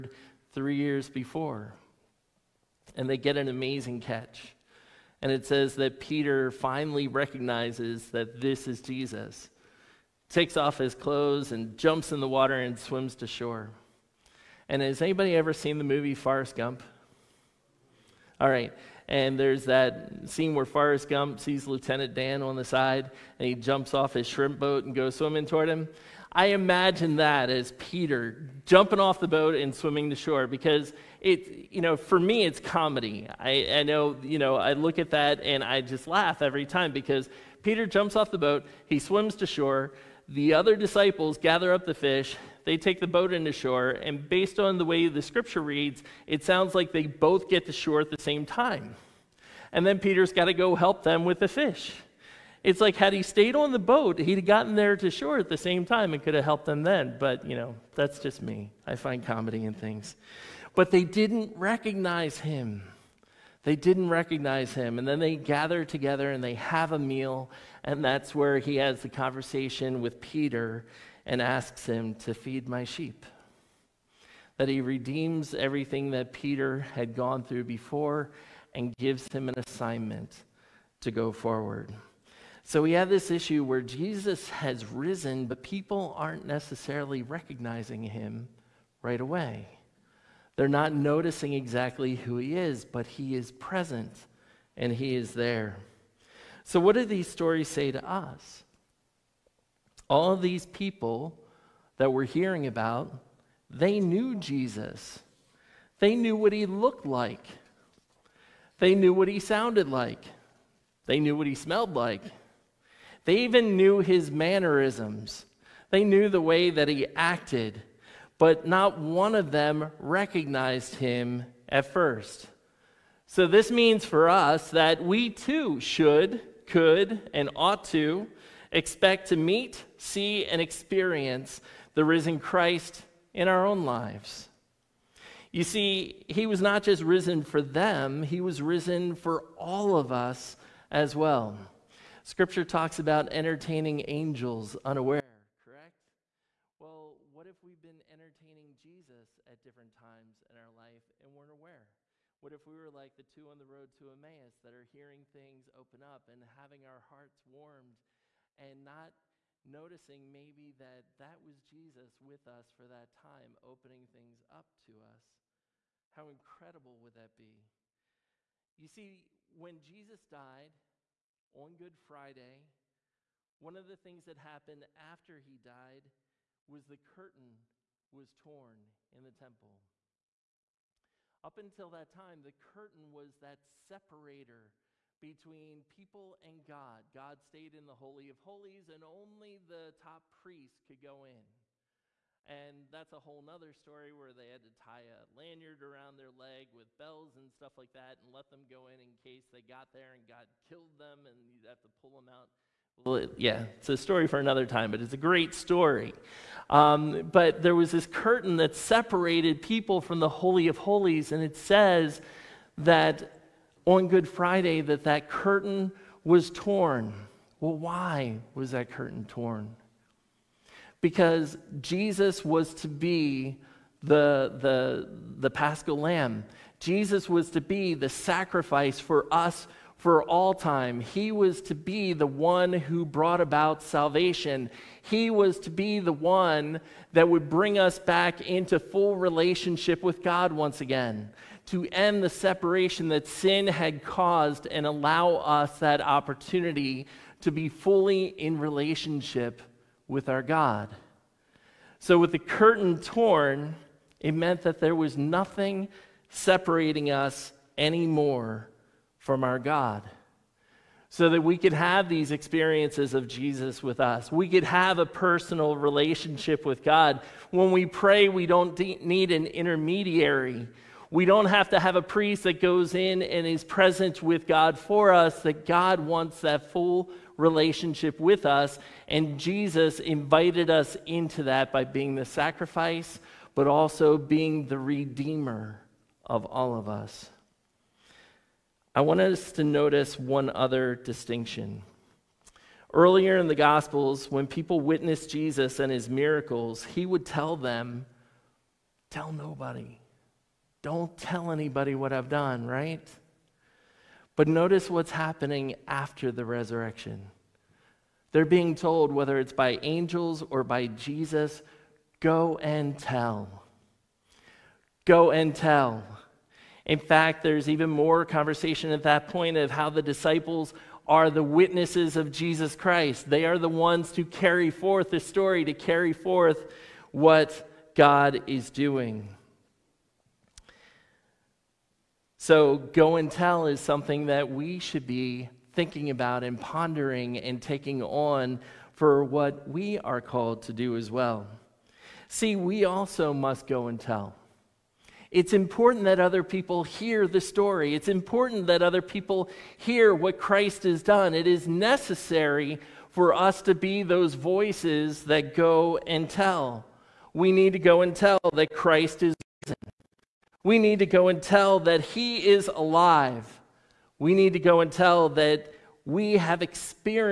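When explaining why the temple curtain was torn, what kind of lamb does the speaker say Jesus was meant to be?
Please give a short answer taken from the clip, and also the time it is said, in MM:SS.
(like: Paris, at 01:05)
Paschal lamb, at 03:45.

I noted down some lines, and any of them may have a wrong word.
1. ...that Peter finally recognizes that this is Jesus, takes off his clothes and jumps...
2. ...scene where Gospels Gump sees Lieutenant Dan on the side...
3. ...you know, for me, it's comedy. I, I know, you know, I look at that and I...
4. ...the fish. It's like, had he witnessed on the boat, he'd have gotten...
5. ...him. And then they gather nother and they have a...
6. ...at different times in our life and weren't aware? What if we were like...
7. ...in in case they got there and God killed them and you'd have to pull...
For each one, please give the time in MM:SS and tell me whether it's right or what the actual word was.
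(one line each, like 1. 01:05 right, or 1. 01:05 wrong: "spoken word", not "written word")
1. 00:05 right
2. 00:20 wrong: "Forrest", not "Gospels"
3. 00:31 right
4. 00:51 wrong: "stayed", not "witnessed"
5. 01:04 wrong: "together", not "nother"
6. 02:29 right
7. 03:18 right.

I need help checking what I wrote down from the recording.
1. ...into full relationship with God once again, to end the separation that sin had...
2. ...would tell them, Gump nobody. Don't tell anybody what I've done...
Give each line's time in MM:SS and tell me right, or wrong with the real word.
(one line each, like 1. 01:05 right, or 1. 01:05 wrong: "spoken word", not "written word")
1. 03:58 right
2. 04:57 wrong: "Tell", not "Gump".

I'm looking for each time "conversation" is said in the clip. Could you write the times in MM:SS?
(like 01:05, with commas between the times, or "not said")
01:09, 05:18.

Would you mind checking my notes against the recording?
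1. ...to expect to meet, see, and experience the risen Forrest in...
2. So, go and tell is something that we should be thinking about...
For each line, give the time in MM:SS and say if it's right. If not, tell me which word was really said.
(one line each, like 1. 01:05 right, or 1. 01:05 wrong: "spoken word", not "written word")
1. 02:07 wrong: "Christ", not "Forrest"
2. 05:32 right.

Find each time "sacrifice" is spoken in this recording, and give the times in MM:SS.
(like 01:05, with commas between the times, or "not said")
03:48, 04:42.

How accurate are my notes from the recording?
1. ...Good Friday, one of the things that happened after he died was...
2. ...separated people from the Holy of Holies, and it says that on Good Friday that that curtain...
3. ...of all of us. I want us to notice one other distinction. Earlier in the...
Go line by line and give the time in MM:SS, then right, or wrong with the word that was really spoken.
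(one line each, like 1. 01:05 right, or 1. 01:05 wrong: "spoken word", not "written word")
1. 02:51 right
2. 03:28 right
3. 04:46 right.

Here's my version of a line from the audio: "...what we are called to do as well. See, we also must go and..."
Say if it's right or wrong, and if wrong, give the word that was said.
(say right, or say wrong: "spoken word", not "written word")
right.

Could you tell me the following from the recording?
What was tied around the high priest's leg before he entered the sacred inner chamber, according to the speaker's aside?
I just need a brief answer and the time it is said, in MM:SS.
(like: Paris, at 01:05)
A lanyard, at 03:15.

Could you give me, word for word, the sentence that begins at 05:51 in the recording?
It is necessary for us to be those voices that go and tell.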